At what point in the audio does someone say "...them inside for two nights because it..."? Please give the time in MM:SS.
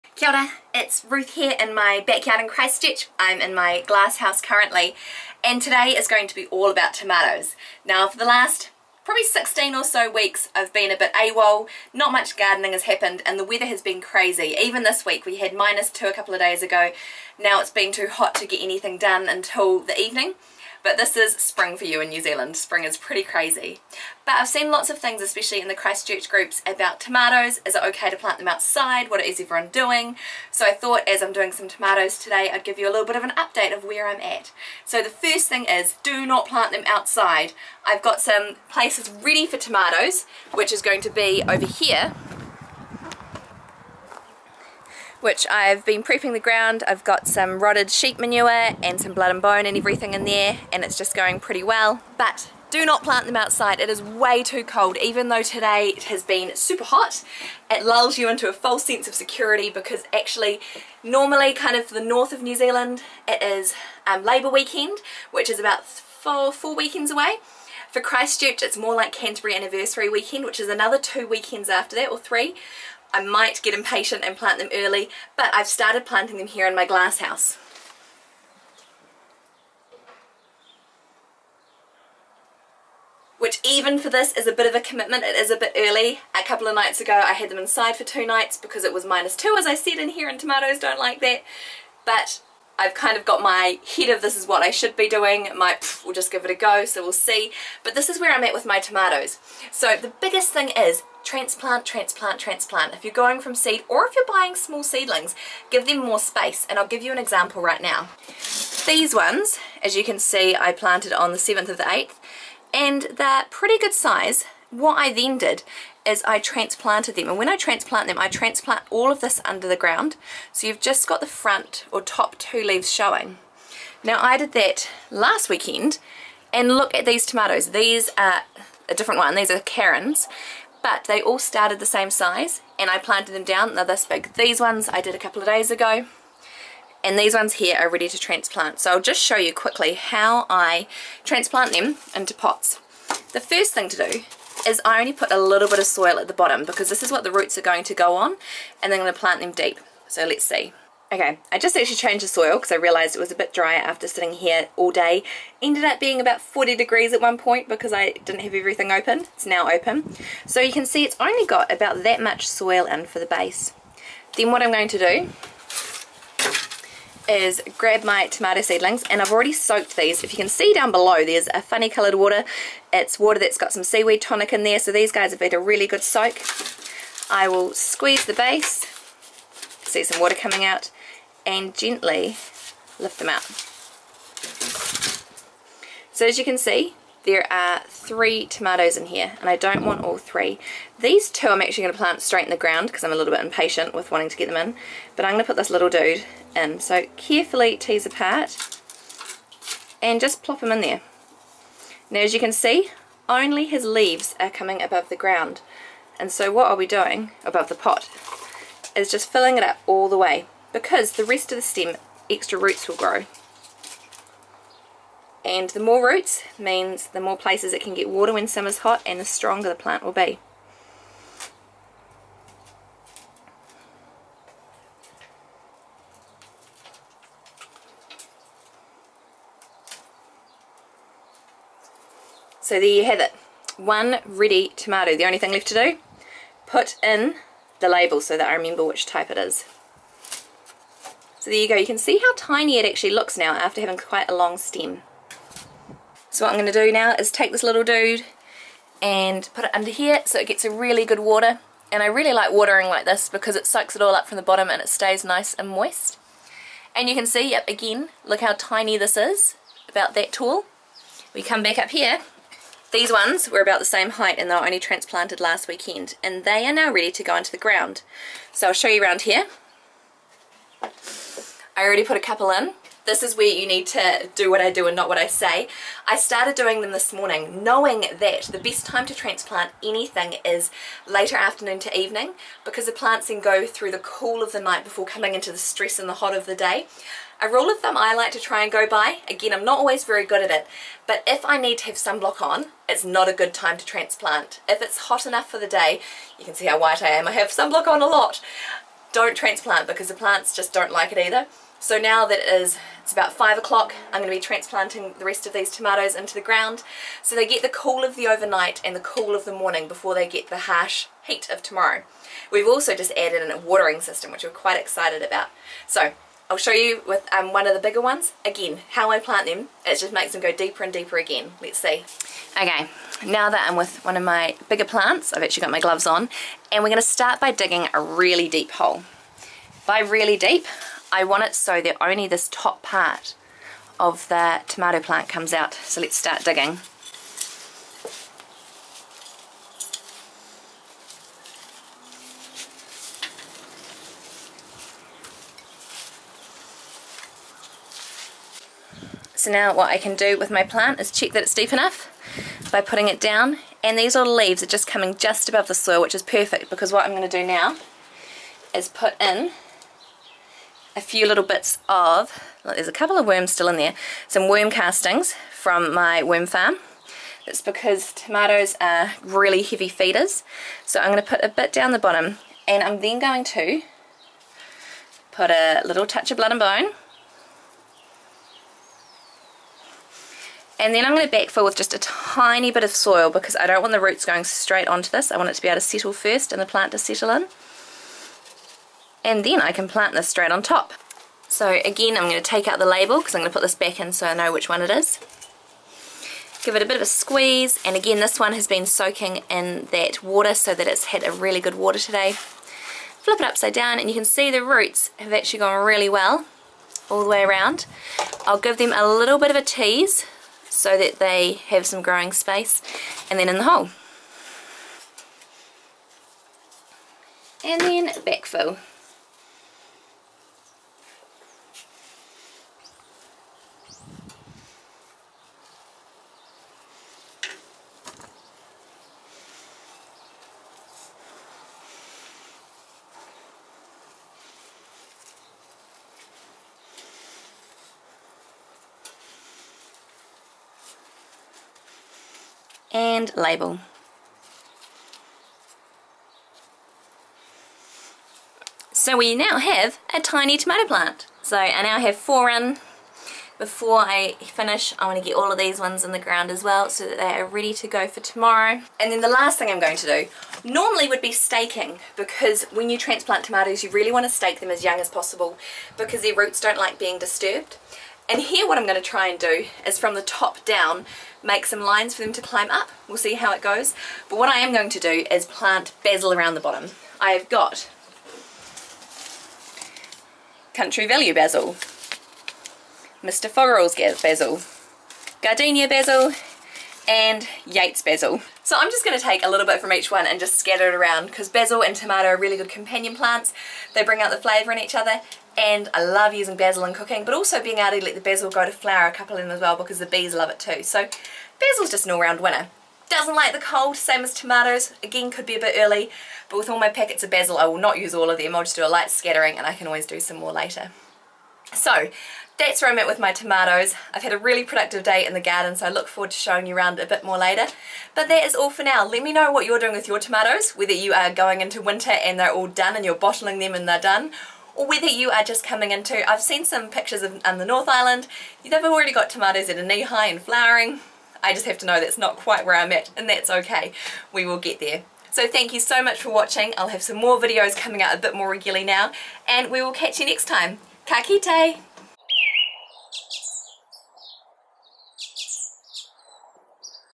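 01:27.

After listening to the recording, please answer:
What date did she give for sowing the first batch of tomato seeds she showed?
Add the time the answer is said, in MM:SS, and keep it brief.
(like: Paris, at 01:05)
7 August, at 01:51.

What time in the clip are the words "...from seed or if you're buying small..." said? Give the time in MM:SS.
01:43.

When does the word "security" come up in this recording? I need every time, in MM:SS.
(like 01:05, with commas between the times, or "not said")
00:59.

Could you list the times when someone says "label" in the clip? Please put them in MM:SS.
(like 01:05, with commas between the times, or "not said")
03:57, 06:32, 07:23.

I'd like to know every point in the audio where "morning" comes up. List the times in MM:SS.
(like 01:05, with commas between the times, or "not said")
04:37, 05:09.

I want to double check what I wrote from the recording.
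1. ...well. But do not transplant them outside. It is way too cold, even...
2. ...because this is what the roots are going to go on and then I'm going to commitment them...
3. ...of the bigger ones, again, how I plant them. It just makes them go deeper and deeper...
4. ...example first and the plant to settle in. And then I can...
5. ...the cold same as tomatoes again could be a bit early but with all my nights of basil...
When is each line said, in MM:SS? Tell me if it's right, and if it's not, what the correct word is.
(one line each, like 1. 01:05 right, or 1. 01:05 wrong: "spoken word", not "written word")
1. 00:51 wrong: "plant", not "transplant"
2. 02:26 wrong: "plant", not "commitment"
3. 05:17 right
4. 06:25 wrong: "settle", not "example"
5. 08:23 wrong: "packets", not "nights".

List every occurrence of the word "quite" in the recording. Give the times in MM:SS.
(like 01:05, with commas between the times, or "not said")
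04:03, 05:14, 08:52.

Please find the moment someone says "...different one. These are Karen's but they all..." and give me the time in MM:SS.
02:08.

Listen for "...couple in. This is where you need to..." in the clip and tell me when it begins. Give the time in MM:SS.
04:32.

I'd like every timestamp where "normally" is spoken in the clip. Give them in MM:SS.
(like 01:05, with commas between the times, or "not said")
01:01, 07:40.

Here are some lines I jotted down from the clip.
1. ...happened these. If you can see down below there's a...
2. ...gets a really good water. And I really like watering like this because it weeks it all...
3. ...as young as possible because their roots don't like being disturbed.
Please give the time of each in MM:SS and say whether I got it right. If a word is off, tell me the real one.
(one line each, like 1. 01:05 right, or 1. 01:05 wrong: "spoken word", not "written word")
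1. 02:49 wrong: "soaked", not "happened"
2. 04:10 wrong: "soaks", not "weeks"
3. 07:44 right.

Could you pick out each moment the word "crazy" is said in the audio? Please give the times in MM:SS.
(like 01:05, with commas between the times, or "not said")
00:13, 00:23.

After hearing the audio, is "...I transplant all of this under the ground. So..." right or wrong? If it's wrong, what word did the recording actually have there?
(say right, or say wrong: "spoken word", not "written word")
right.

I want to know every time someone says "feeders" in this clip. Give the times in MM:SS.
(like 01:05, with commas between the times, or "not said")
06:09.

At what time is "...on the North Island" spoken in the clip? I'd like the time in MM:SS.
08:47.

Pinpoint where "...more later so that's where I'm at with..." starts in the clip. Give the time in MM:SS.
08:30.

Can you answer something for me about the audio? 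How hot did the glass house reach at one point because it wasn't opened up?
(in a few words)
40 degrees.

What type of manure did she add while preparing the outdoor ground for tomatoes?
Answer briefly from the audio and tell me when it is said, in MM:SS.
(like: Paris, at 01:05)
Sheep manure, at 00:47.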